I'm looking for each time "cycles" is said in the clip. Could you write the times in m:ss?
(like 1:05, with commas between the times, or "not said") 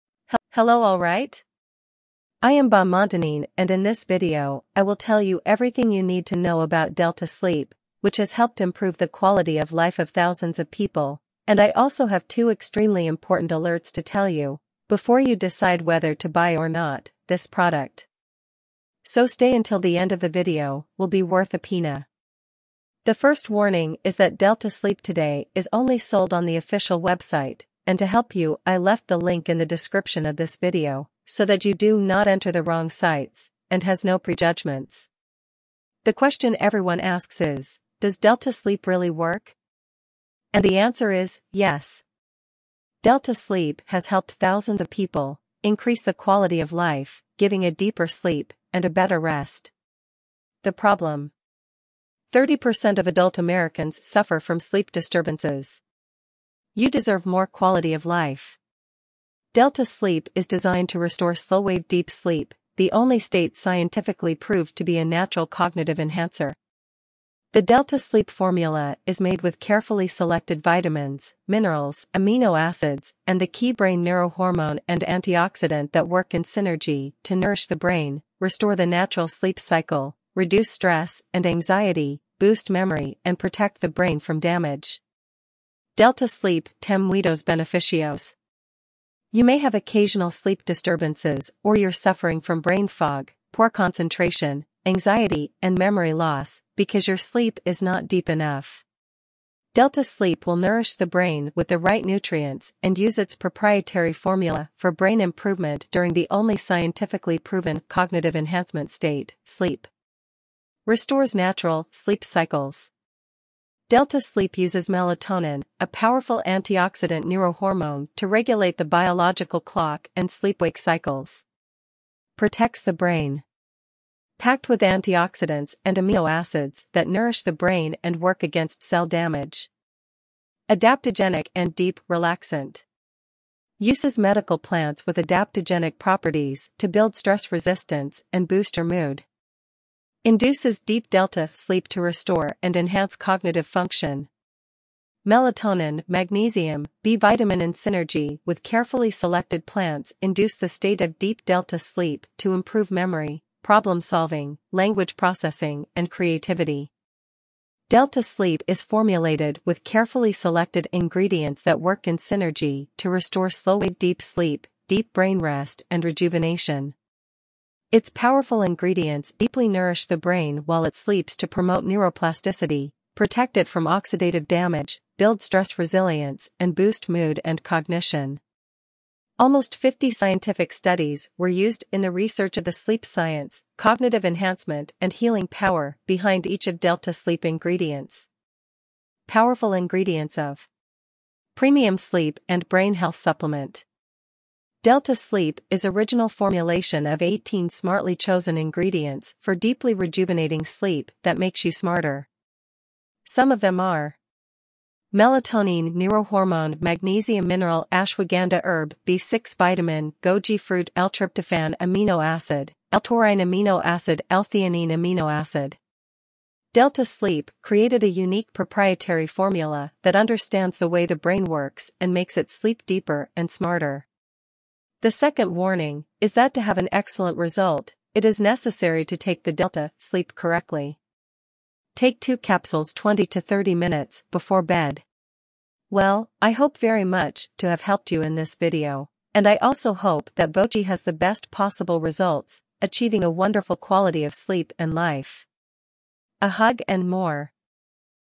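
1:19, 1:52, 2:00.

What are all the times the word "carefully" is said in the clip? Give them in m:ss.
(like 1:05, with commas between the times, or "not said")
1:09, 2:28, 2:39.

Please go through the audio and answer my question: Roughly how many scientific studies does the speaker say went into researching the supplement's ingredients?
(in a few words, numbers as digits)
Almost 50.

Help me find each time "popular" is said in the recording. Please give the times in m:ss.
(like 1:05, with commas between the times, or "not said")
not said.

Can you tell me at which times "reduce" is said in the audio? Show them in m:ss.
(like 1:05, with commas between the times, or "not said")
1:20.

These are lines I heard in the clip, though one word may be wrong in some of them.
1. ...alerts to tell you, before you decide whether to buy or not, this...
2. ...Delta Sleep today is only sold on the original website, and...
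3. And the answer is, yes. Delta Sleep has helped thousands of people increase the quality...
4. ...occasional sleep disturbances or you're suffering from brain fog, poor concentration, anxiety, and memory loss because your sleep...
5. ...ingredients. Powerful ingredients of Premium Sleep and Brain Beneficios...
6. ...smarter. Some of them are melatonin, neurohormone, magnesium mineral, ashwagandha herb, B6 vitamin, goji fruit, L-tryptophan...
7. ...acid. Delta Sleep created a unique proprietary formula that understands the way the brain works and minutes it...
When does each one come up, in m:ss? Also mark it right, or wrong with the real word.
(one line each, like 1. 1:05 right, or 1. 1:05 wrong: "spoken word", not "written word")
1. 0:13 right
2. 0:24 wrong: "official", not "original"
3. 0:40 right
4. 1:29 right
5. 3:07 wrong: "Health", not "Beneficios"
6. 3:21 right
7. 3:35 wrong: "makes", not "minutes".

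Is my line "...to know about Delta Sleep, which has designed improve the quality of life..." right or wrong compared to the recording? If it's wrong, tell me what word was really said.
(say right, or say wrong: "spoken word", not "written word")
wrong: "helped", not "designed".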